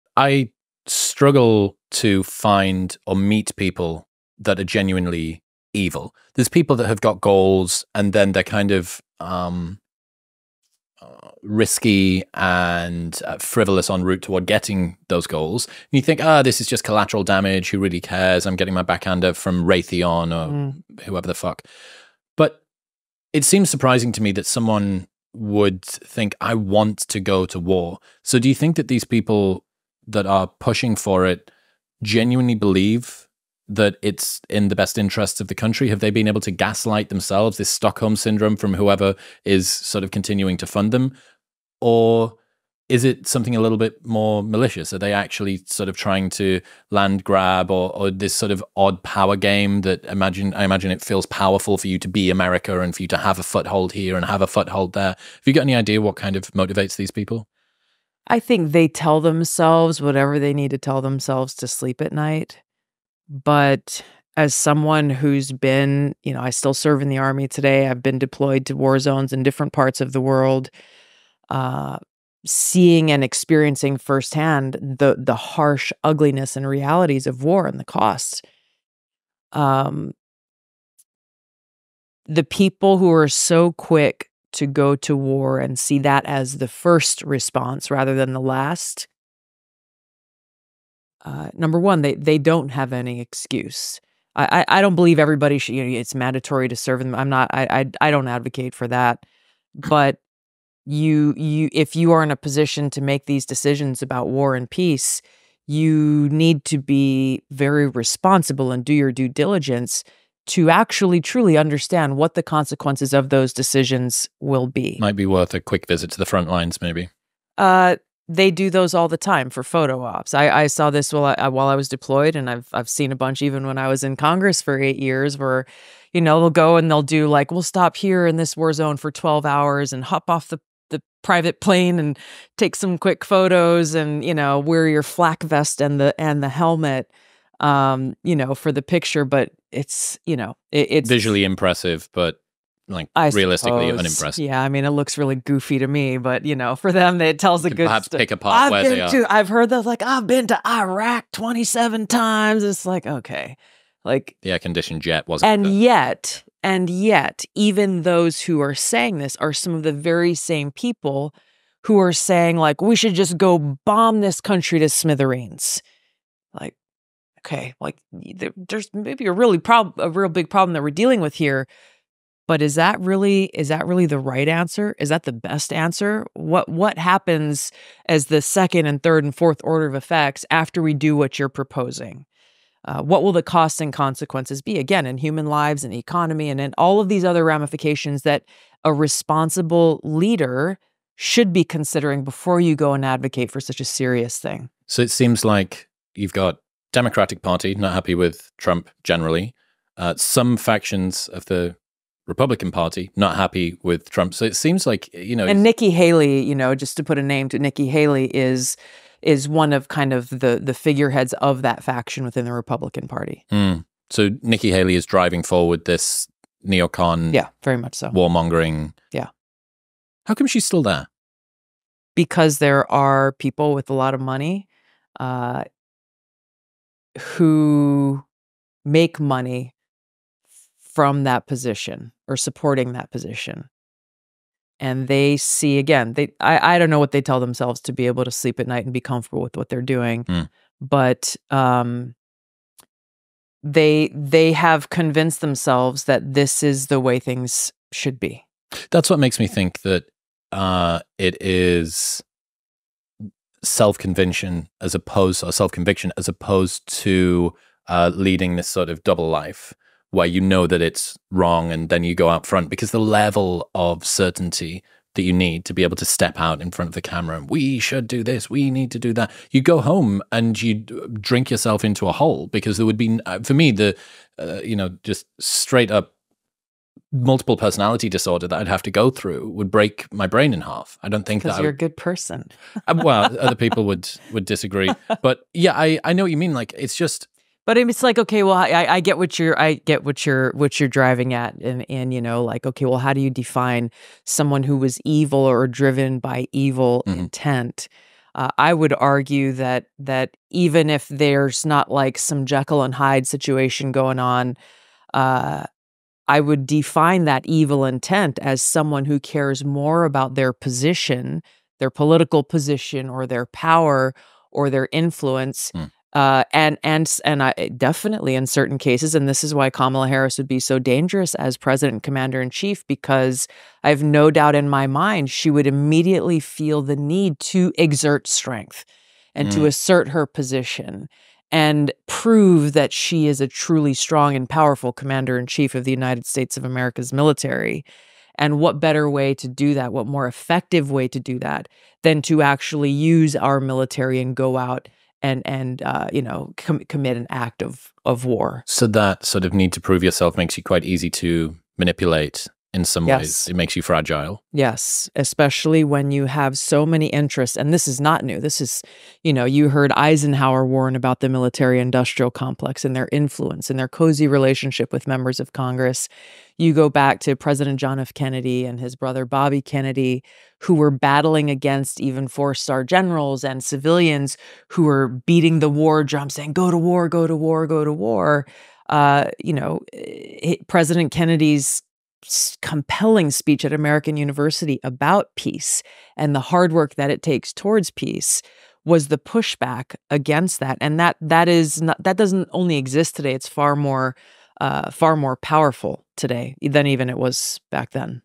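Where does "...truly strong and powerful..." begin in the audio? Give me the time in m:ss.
5:33.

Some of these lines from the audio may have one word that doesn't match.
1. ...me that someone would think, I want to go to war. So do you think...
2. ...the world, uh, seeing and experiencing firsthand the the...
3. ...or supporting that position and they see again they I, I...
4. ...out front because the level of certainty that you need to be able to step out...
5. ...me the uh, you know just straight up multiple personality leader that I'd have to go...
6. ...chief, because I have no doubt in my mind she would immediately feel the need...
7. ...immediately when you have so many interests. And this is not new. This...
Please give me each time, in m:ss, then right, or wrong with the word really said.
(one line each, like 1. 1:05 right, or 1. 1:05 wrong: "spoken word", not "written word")
1. 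0:24 right
2. 1:10 right
3. 3:52 right
4. 4:22 right
5. 4:33 wrong: "disorder", not "leader"
6. 5:22 right
7. 5:55 wrong: "especially", not "immediately".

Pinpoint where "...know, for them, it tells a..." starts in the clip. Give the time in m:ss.
2:26.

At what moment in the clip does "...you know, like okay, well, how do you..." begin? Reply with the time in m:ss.
4:52.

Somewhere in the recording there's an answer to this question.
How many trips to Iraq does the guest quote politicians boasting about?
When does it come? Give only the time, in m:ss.
2:31.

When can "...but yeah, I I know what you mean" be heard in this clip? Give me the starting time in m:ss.
4:45.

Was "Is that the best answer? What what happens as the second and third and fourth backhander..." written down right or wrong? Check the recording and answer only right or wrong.
wrong.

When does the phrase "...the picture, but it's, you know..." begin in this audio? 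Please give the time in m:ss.
2:18.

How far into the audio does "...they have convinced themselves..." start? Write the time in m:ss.
4:04.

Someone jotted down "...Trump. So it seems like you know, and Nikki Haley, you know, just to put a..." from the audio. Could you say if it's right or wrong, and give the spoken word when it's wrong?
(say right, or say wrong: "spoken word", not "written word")
right.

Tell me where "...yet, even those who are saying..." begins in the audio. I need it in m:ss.
2:36.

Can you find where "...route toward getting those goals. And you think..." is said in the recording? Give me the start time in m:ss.
0:14.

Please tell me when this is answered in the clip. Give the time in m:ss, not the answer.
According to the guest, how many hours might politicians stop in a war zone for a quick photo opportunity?
2:09.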